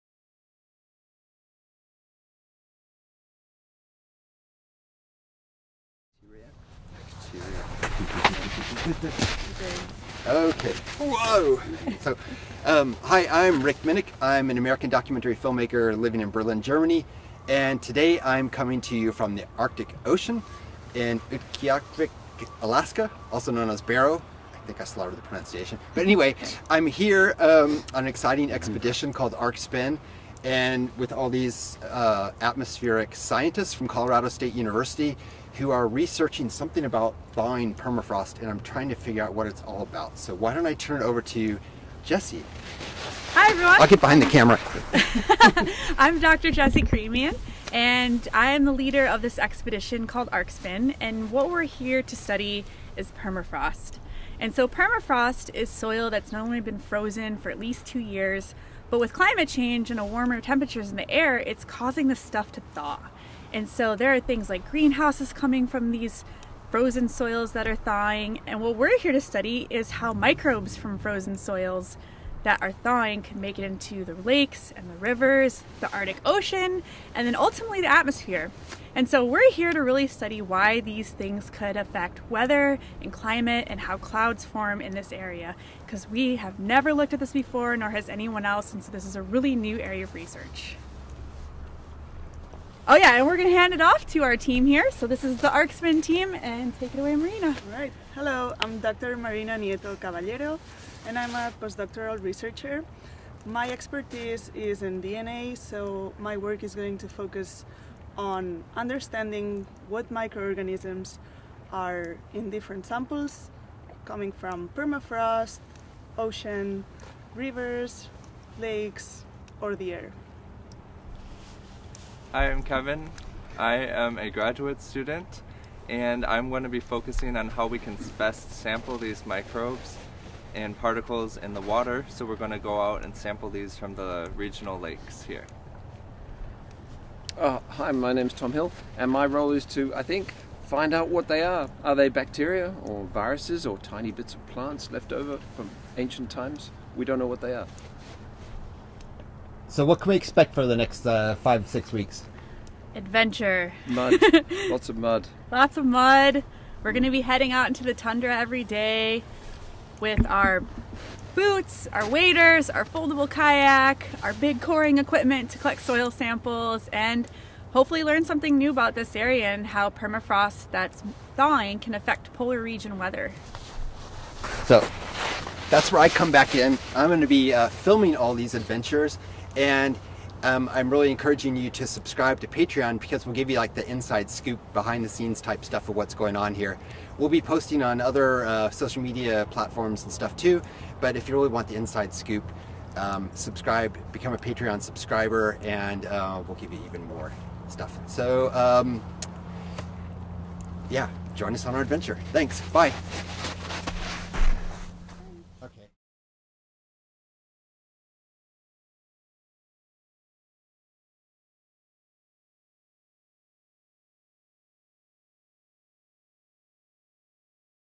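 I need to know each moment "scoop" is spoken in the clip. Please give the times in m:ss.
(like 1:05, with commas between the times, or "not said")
3:04, 3:12.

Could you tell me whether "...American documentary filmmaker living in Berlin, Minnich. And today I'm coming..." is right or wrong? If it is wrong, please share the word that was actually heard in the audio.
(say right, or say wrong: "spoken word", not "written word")
wrong: "Germany", not "Minnich".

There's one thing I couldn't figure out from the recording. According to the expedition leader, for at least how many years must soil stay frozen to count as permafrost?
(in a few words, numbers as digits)
2.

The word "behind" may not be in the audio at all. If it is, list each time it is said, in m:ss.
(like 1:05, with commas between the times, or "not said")
0:44, 3:04.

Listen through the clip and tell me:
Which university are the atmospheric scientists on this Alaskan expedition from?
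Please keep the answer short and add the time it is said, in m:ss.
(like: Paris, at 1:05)
Colorado State University, at 0:33.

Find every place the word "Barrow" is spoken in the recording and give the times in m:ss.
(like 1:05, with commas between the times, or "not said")
0:23.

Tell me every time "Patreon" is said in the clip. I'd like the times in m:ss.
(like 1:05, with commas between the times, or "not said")
3:02, 3:14.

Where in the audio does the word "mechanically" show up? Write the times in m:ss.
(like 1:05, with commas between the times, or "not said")
not said.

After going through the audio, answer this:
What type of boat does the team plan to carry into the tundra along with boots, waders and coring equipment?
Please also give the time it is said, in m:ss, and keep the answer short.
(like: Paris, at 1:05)
foldable kayak, at 2:42.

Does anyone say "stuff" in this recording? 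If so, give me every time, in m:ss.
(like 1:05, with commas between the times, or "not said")
1:02, 3:05, 3:10, 3:17.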